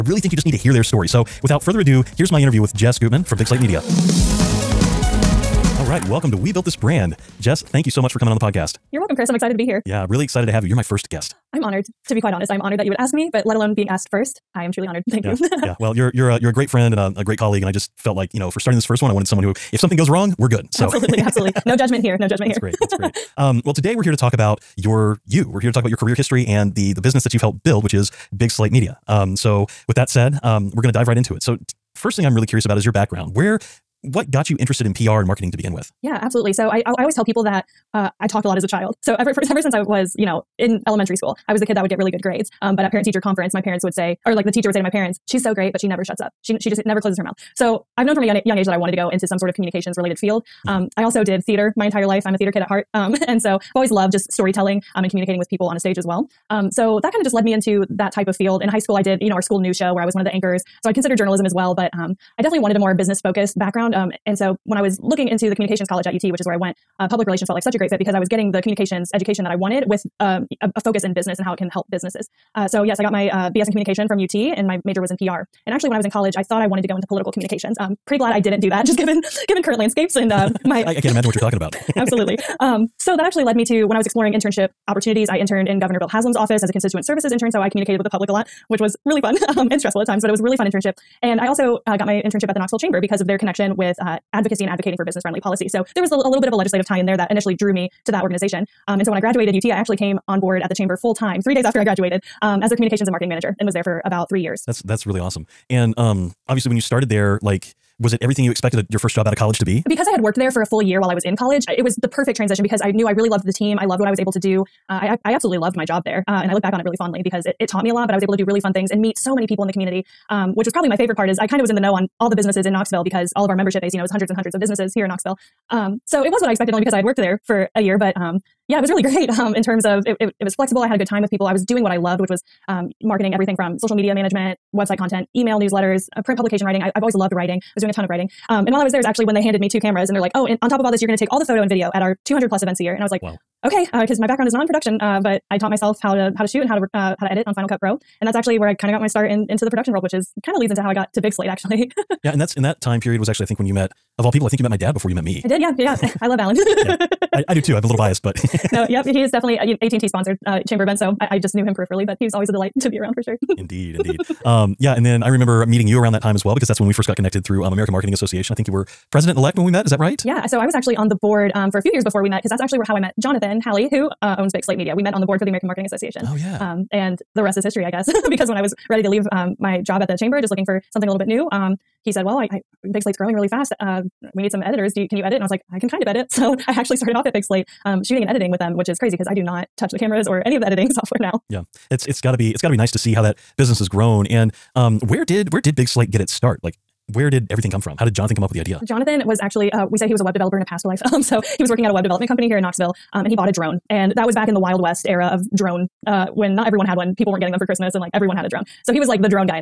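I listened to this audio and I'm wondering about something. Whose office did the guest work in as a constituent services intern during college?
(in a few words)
Governor Bill Haslam.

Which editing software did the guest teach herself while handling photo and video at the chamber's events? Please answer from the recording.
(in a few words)
Final Cut Pro.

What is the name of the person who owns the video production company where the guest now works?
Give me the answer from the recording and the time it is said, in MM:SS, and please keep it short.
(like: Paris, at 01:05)
Jonathan Halley, at 02:53.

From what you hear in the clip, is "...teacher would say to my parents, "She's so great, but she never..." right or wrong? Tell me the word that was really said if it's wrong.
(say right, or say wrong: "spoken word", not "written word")
right.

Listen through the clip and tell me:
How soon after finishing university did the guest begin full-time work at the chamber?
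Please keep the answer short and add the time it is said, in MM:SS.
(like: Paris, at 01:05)
3 days, at 01:41.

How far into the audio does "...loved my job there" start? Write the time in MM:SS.
01:55.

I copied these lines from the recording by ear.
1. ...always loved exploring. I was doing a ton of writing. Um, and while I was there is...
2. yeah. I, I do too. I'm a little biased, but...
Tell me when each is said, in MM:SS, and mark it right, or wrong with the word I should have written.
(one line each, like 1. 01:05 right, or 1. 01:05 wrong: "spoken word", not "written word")
1. 02:17 wrong: "writing", not "exploring"
2. 02:36 right.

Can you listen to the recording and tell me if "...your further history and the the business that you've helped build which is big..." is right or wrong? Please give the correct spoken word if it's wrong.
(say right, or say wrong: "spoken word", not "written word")
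wrong: "career", not "further".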